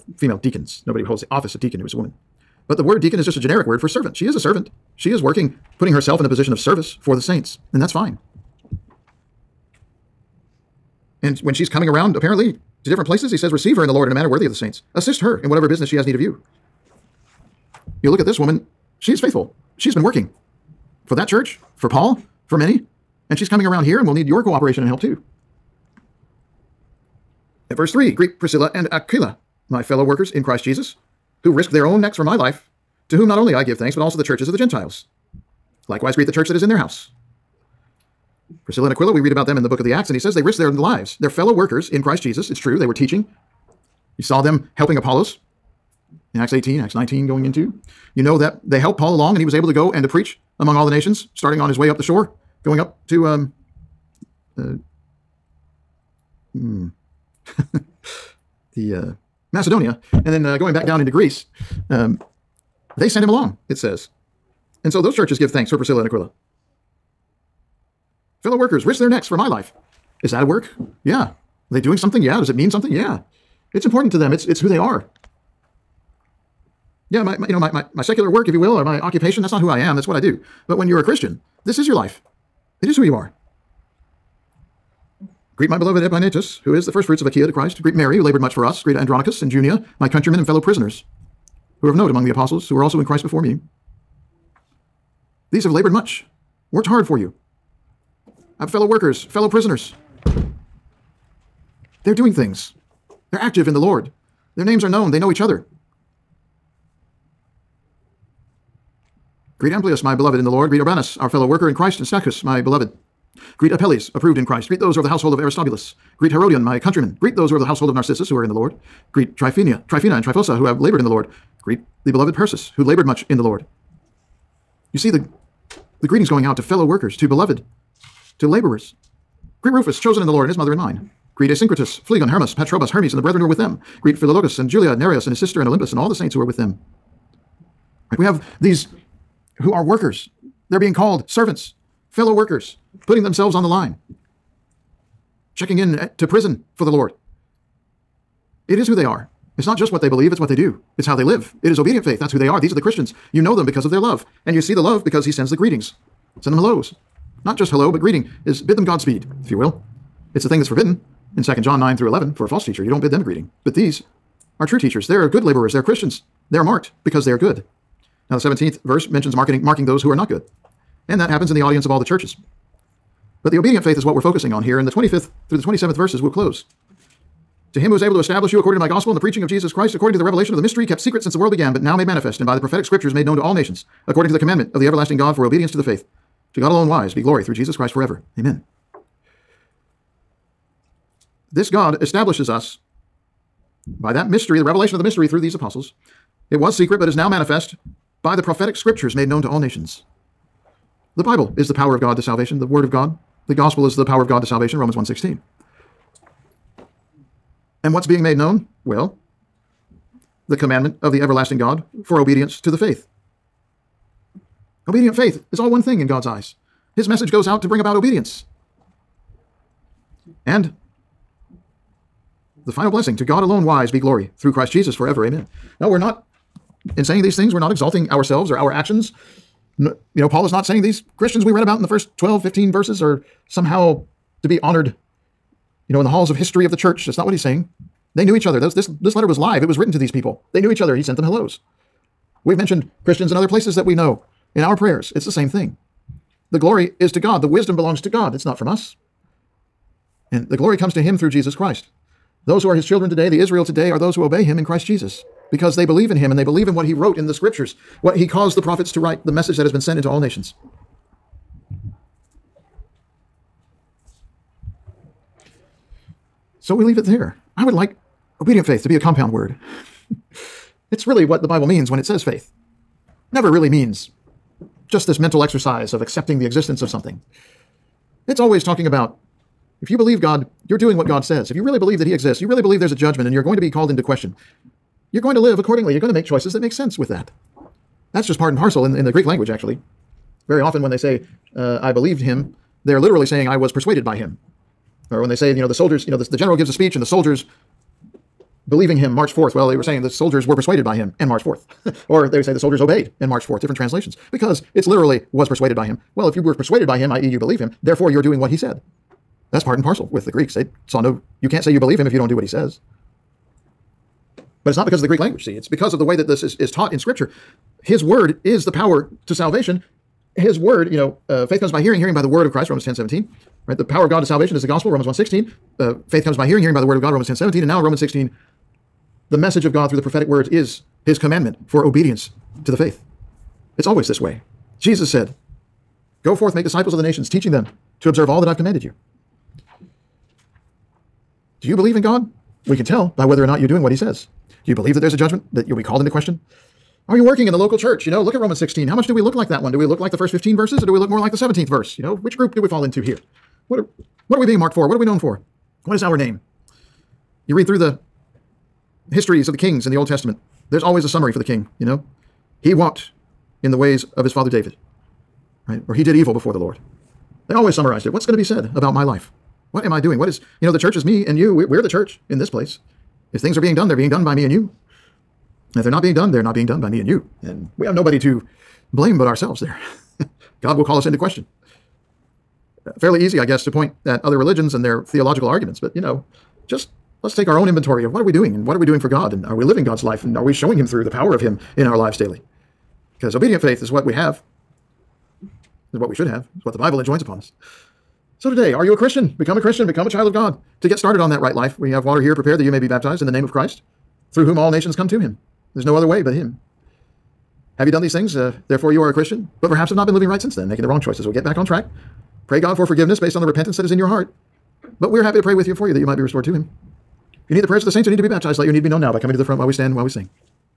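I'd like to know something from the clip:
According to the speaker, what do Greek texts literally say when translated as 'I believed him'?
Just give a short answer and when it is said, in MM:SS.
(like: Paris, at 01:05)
I was persuaded by him, at 04:53.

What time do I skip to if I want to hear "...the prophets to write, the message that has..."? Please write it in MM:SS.
04:18.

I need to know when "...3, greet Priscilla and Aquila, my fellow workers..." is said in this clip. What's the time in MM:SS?
00:27.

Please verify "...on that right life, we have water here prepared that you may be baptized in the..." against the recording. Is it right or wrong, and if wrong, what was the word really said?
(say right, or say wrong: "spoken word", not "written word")
right.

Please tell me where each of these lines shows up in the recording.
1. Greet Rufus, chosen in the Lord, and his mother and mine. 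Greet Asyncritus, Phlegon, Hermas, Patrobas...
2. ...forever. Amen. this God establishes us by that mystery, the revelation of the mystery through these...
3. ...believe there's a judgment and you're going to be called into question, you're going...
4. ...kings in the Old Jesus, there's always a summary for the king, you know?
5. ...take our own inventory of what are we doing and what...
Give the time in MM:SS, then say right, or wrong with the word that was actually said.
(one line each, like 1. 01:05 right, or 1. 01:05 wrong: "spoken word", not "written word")
1. 02:09 right
2. 03:07 right
3. 04:42 right
4. 05:59 wrong: "Testament", not "Jesus"
5. 06:27 right.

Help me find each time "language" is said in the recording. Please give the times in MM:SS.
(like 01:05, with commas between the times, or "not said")
04:49, 05:15.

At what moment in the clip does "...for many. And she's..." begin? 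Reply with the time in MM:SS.
00:22.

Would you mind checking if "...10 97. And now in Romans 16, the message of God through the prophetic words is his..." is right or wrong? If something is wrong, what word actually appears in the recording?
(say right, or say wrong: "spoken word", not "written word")
wrong: "17", not "97".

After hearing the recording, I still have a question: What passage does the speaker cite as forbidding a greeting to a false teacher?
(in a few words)
2 John 9 through 11.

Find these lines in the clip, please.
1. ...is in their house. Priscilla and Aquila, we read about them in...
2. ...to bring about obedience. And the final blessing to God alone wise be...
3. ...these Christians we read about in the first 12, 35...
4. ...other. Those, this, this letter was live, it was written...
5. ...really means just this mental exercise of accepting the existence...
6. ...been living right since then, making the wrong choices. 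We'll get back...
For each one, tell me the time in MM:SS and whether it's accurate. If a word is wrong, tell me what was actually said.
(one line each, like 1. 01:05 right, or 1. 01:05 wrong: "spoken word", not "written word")
1. 00:36 right
2. 03:37 right
3. 03:50 wrong: "15", not "35"
4. 03:58 right
5. 04:33 right
6. 06:50 right.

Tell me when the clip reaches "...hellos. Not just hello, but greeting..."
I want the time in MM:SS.
02:36.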